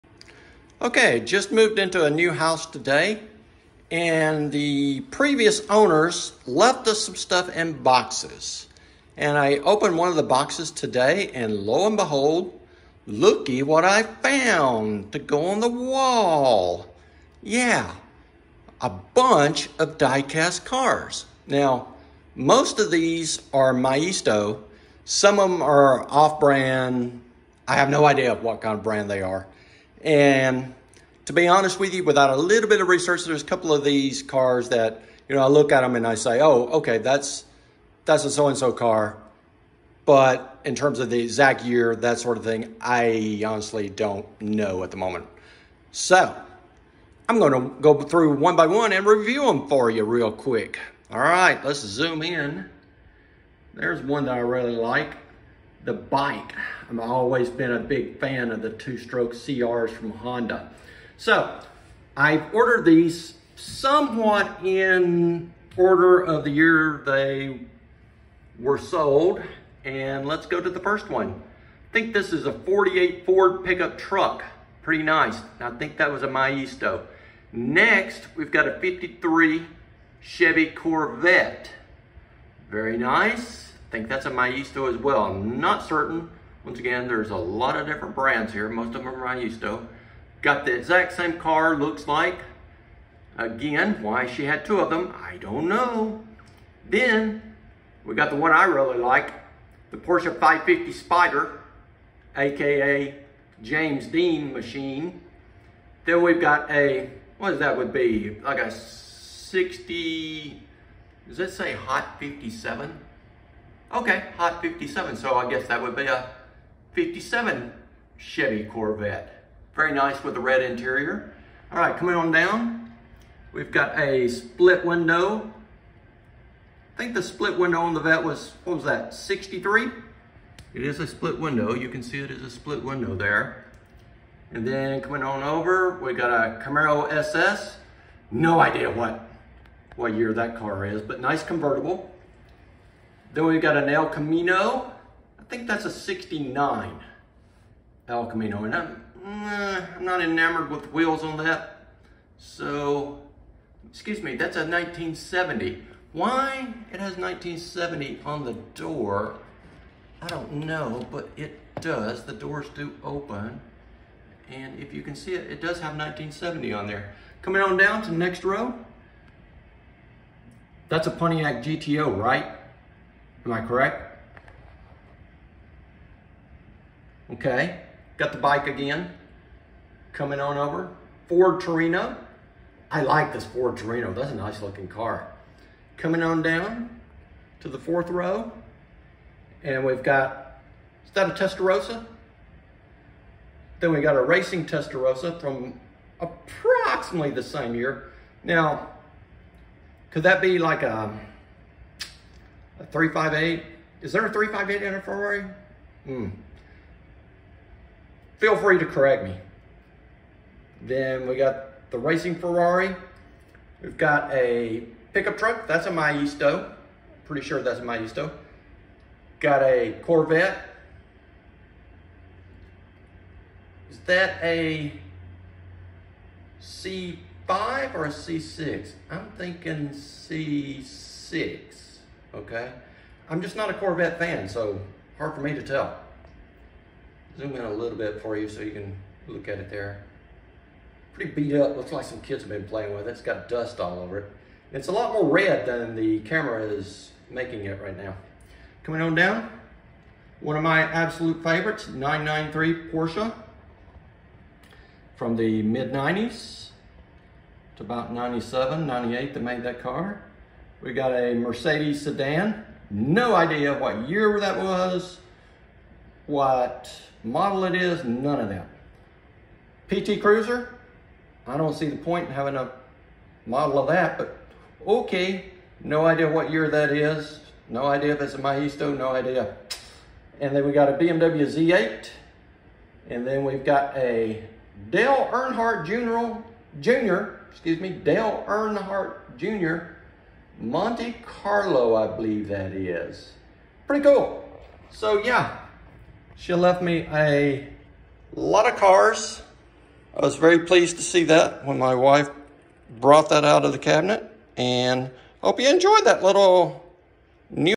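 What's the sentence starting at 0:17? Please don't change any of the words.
Yeah, a bunch of die-cast cars.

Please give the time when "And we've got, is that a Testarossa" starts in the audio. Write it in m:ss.
3:09.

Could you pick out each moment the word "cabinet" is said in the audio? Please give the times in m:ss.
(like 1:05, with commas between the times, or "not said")
5:03.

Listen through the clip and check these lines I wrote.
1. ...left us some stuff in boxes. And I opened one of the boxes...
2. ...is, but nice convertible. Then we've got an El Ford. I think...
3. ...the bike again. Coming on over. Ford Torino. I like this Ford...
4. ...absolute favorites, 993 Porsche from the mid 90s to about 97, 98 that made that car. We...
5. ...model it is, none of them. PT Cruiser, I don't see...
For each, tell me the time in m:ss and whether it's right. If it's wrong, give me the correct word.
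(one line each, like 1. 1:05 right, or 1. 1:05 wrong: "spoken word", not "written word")
1. 0:06 right
2. 2:20 wrong: "Camino", not "Ford"
3. 2:58 right
4. 4:10 right
5. 4:27 right.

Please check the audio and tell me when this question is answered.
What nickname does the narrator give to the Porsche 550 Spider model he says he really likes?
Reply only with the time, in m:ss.
1:43.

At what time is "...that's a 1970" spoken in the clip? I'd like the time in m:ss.
2:34.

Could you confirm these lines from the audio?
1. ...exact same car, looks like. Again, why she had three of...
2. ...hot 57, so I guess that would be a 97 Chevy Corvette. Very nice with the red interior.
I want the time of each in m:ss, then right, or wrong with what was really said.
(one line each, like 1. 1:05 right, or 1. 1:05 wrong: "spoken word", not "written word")
1. 1:30 wrong: "two", not "three"
2. 1:54 wrong: "57", not "97".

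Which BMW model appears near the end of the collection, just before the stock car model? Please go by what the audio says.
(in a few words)
BMW Z8.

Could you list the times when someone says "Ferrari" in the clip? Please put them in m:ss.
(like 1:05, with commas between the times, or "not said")
3:25, 3:32.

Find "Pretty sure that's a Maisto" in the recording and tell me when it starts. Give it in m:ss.
3:37.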